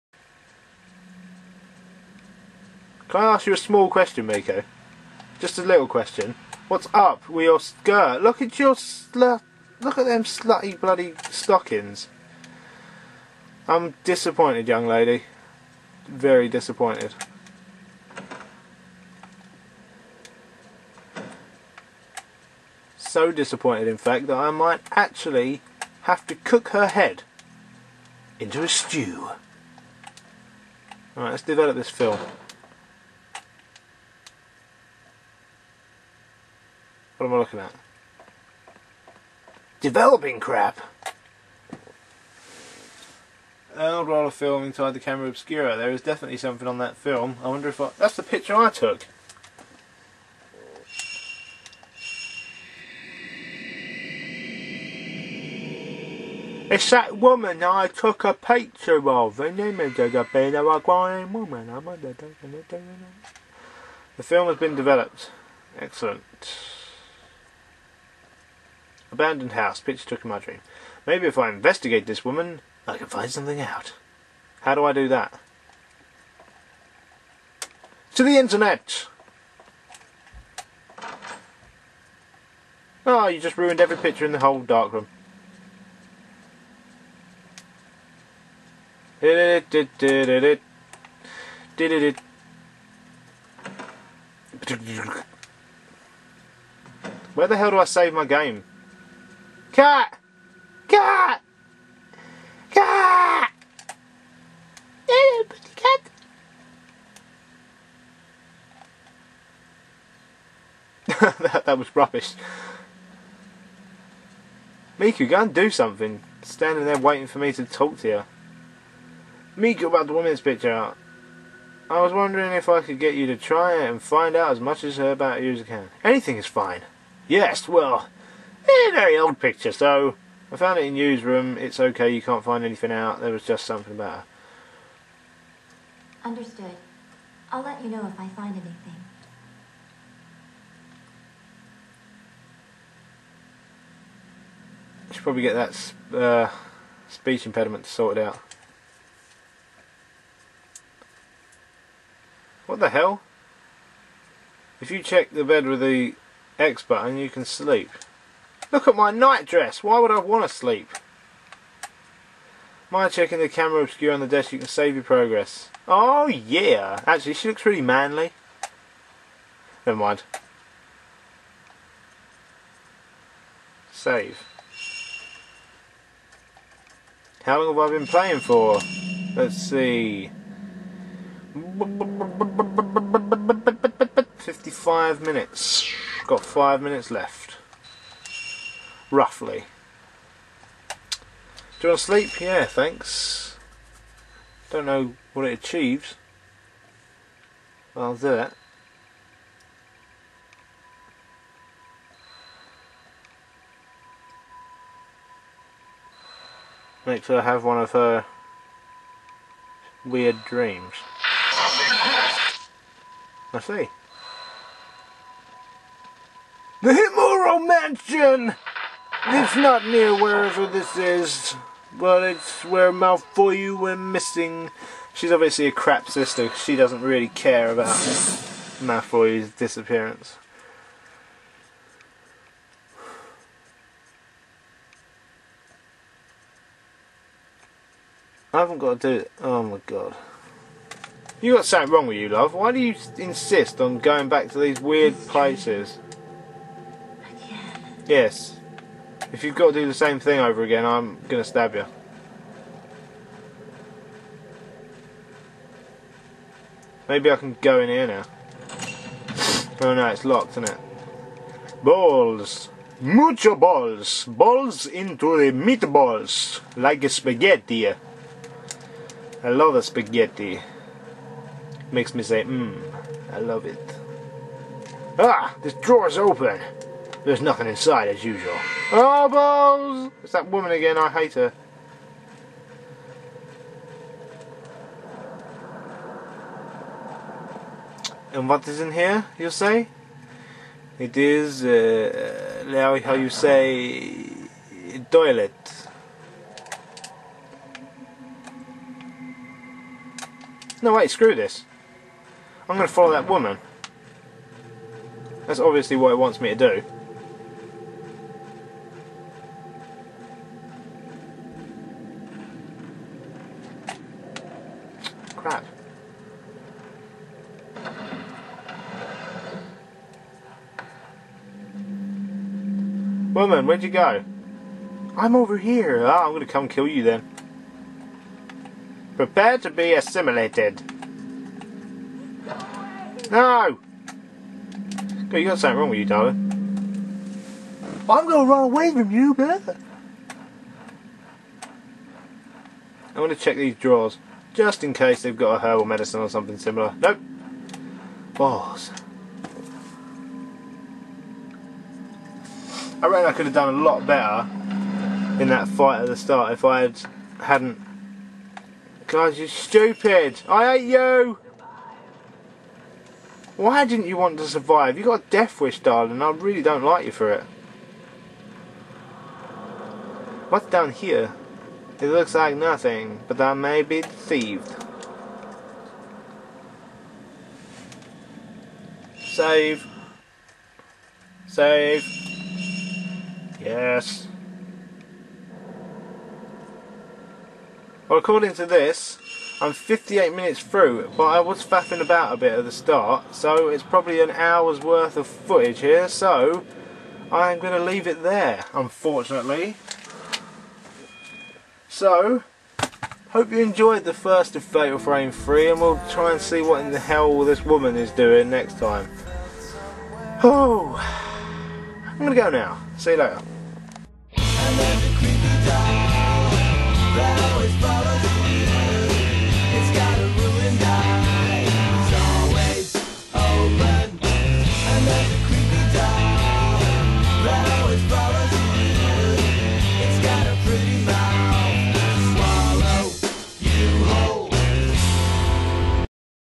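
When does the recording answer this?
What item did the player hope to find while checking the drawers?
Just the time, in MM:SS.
05:45.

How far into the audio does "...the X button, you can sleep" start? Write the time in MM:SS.
02:35.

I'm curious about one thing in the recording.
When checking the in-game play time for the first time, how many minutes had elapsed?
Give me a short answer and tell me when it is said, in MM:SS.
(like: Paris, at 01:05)
55, at 03:04.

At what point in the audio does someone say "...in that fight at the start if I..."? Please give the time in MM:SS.
05:55.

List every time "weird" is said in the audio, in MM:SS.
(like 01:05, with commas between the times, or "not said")
03:30, 04:04.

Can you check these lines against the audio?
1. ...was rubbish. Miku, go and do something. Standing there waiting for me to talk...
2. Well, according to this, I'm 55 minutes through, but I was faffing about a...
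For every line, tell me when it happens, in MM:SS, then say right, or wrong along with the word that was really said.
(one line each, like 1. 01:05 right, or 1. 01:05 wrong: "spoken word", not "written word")
1. 01:51 right
2. 06:28 wrong: "58", not "55".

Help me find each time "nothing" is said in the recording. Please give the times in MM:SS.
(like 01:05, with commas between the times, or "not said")
04:37, 06:12.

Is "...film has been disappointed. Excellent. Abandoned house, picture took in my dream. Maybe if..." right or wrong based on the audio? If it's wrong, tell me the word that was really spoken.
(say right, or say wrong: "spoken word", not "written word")
wrong: "developed", not "disappointed".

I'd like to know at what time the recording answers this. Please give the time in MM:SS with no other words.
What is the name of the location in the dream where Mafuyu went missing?
03:36.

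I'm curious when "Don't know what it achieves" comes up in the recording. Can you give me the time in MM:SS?
03:14.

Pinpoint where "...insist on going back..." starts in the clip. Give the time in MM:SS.
04:03.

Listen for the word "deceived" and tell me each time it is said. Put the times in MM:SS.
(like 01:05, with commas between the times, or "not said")
06:14.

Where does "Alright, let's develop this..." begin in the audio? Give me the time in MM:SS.
00:31.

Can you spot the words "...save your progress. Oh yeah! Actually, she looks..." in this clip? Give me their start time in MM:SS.
02:44.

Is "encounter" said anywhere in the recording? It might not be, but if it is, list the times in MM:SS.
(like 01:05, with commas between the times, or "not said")
not said.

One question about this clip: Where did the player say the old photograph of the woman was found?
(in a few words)
newsroom.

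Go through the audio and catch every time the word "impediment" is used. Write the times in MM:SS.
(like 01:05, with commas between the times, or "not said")
02:27.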